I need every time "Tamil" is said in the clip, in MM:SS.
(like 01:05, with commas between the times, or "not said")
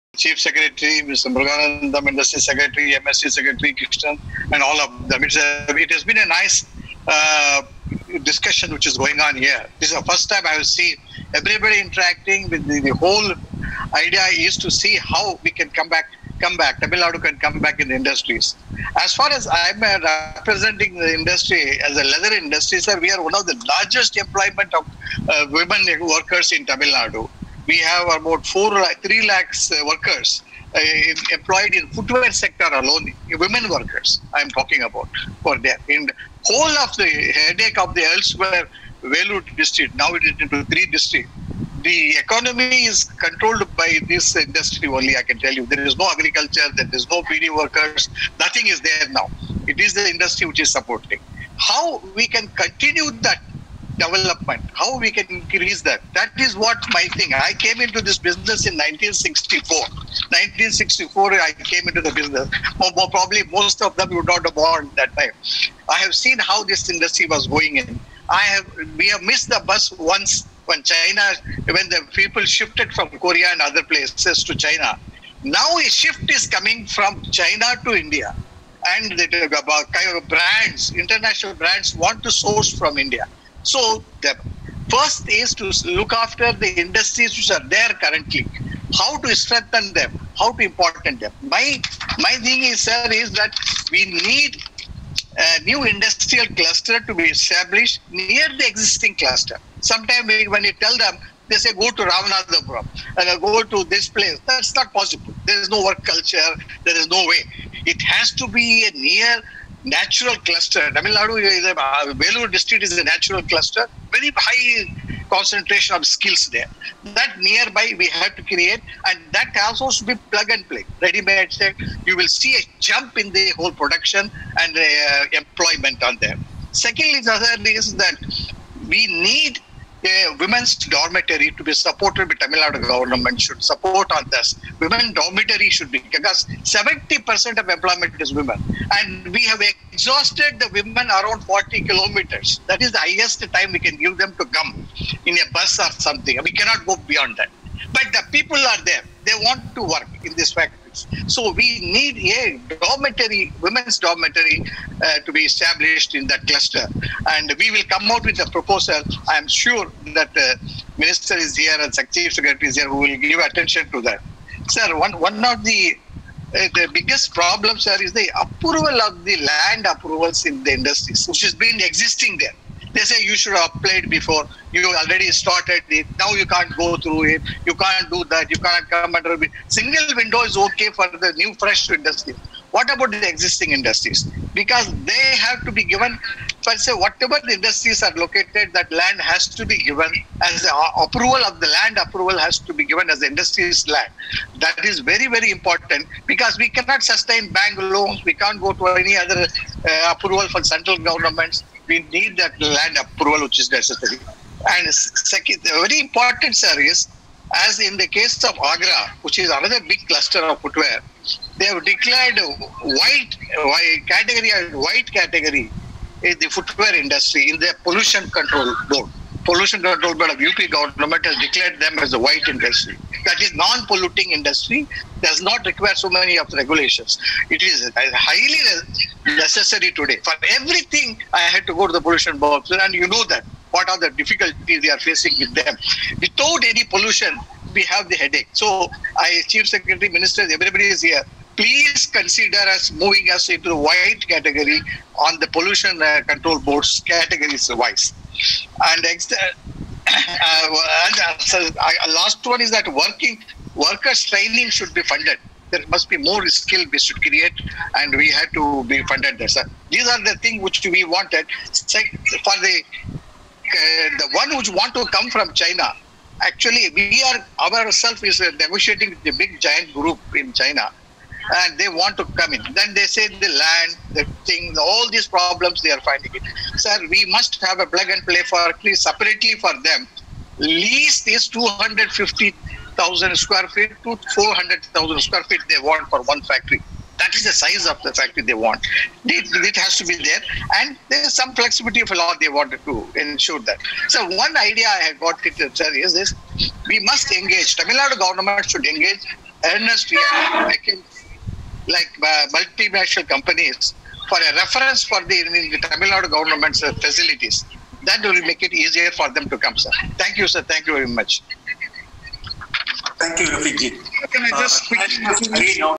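00:16, 00:26, 01:50, 02:12, 04:57, 05:05.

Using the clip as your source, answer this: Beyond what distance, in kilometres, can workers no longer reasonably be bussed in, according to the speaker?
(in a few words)
40 kilometers.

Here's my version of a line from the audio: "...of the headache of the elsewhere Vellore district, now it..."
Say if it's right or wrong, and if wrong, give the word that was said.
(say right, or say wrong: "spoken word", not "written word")
right.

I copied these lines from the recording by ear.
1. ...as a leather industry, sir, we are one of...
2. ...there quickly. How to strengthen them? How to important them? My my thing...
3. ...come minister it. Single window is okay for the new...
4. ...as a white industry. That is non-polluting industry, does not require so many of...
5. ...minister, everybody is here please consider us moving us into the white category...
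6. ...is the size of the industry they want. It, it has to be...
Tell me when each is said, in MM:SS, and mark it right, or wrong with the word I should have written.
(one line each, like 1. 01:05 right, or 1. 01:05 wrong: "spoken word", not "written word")
1. 00:21 right
2. 01:27 wrong: "currently", not "quickly"
3. 02:58 wrong: "under", not "minister"
4. 03:41 right
5. 04:00 right
6. 04:47 wrong: "factory", not "industry".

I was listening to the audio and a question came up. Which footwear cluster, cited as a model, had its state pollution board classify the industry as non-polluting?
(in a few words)
Agra.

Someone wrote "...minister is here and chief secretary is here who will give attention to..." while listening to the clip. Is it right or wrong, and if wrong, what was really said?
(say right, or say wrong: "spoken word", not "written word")
right.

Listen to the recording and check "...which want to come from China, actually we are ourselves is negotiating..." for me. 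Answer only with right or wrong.
right.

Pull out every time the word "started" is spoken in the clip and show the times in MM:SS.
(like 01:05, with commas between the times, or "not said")
02:55.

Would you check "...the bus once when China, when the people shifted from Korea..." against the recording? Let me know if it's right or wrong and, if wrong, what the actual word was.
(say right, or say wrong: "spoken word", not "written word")
right.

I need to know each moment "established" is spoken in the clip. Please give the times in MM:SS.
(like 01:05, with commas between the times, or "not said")
01:37, 02:35.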